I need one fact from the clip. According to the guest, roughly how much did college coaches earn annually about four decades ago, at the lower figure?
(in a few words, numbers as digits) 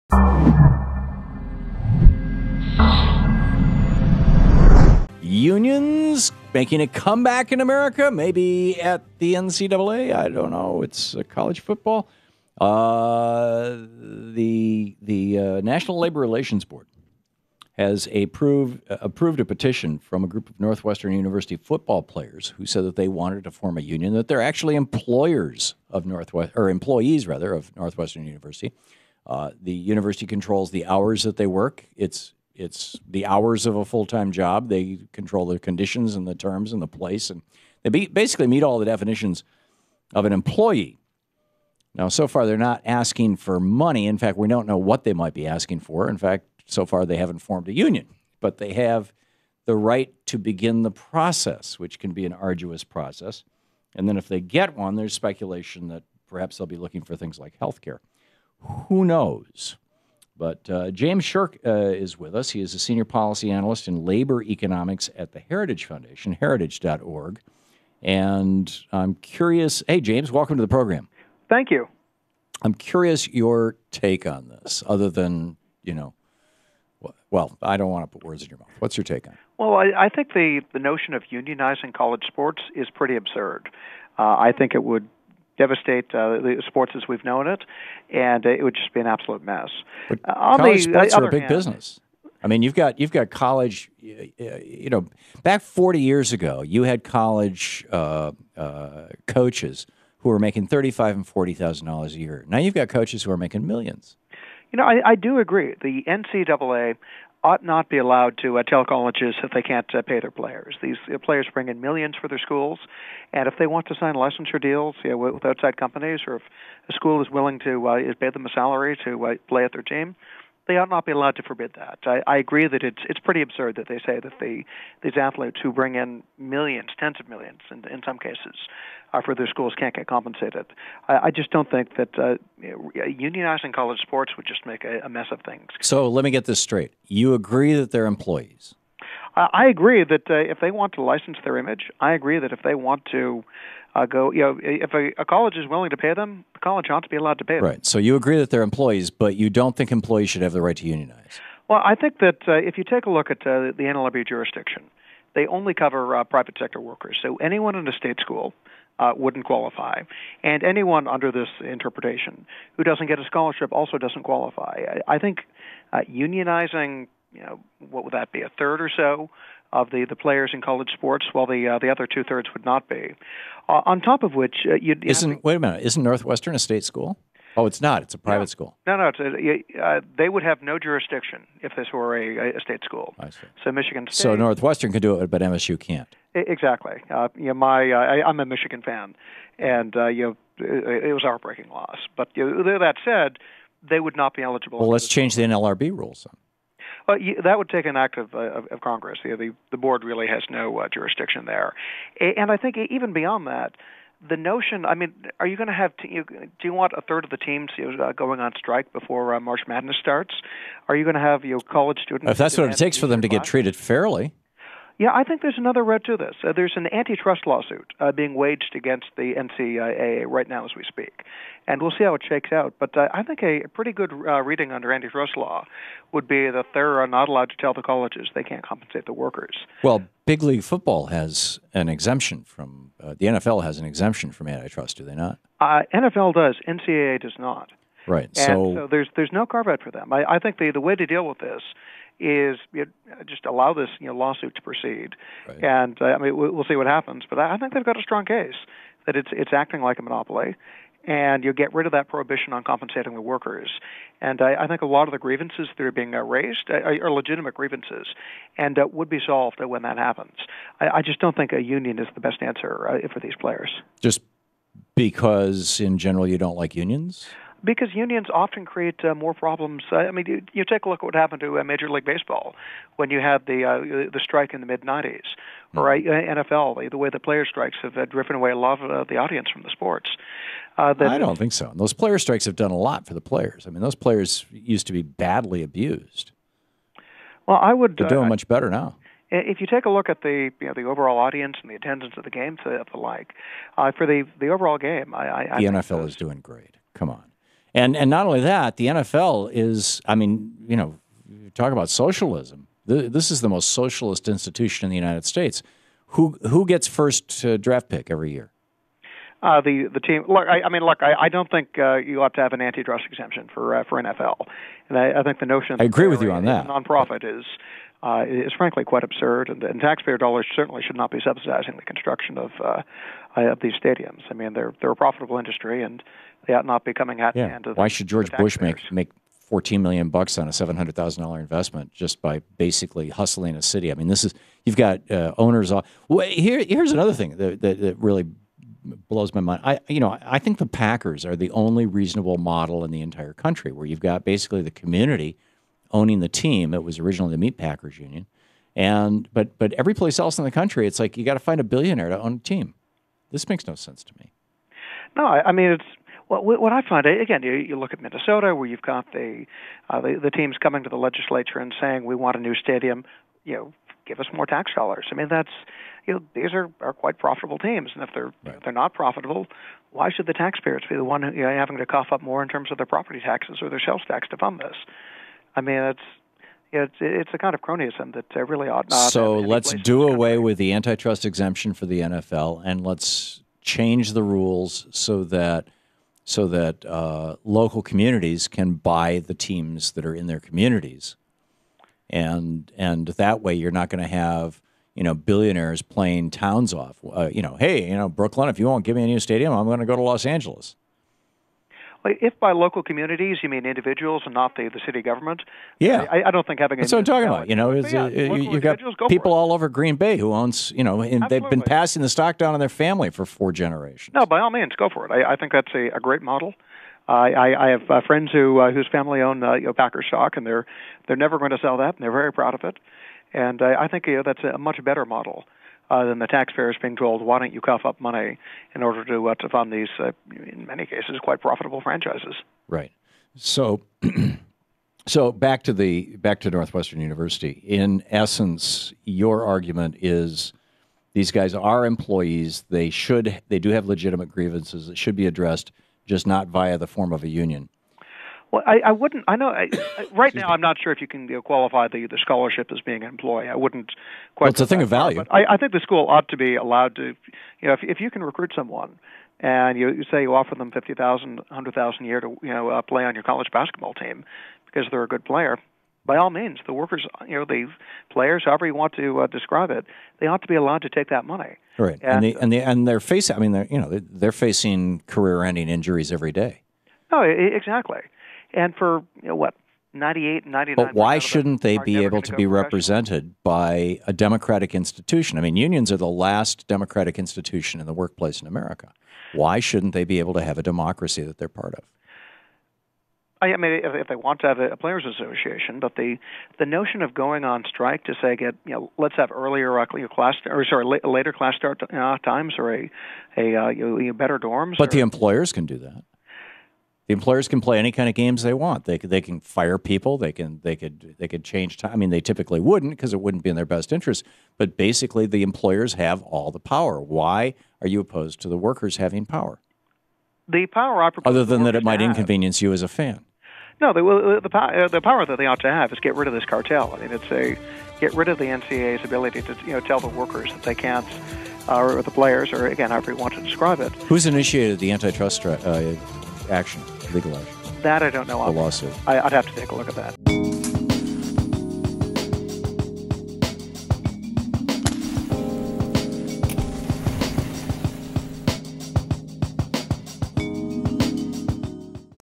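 35,000 dollars.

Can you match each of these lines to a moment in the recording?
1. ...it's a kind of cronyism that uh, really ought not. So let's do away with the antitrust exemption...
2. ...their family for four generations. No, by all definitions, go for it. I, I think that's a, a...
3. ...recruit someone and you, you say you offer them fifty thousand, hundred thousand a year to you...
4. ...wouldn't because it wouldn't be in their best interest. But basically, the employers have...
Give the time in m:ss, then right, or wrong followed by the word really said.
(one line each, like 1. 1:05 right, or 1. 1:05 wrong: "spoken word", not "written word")
1. 6:17 right
2. 6:52 wrong: "means", not "definitions"
3. 7:38 right
4. 8:32 right.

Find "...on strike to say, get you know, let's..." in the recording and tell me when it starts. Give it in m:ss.
8:17.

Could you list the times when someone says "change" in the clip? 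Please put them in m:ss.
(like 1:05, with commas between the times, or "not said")
3:15, 6:23, 8:31.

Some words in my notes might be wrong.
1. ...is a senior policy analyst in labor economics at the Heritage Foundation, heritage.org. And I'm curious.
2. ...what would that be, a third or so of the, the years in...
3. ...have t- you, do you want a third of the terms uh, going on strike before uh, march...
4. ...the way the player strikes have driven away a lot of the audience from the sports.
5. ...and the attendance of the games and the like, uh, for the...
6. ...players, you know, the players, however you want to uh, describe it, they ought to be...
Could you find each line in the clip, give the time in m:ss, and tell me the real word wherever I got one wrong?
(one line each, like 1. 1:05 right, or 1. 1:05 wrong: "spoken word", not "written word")
1. 1:02 right
2. 2:47 wrong: "players", not "years"
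3. 3:25 wrong: "teams", not "terms"
4. 4:36 right
5. 4:51 right
6. 7:46 wrong: "workers", not "players".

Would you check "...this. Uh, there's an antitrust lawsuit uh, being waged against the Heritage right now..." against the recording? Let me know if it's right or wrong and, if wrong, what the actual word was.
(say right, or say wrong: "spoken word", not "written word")
wrong: "NCAA", not "Heritage".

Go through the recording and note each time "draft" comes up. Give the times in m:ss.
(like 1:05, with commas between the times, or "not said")
5:07.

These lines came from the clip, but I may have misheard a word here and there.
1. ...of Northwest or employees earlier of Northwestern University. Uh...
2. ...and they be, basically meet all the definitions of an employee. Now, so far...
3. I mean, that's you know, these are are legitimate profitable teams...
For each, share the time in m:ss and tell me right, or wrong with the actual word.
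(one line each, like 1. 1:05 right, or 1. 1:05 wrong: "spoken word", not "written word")
1. 0:25 wrong: "rather", not "earlier"
2. 0:37 right
3. 6:05 wrong: "quite", not "legitimate".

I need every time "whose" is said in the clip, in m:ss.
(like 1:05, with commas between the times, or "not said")
6:58.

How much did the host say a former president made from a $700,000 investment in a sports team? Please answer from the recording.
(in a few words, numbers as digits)
14 million dollars.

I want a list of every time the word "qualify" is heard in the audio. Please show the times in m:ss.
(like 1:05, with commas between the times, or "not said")
2:39, 2:44, 7:31.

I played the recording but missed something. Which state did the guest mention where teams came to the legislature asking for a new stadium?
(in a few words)
Minnesota.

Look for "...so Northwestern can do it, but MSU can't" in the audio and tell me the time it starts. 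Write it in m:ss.
3:04.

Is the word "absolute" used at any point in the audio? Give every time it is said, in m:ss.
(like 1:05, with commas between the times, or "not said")
1:29.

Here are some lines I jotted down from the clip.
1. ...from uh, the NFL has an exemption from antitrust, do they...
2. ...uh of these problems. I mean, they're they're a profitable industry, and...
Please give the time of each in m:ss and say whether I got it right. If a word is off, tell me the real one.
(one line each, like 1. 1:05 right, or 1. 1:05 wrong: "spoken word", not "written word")
1. 3:52 right
2. 5:23 wrong: "stadiums", not "problems".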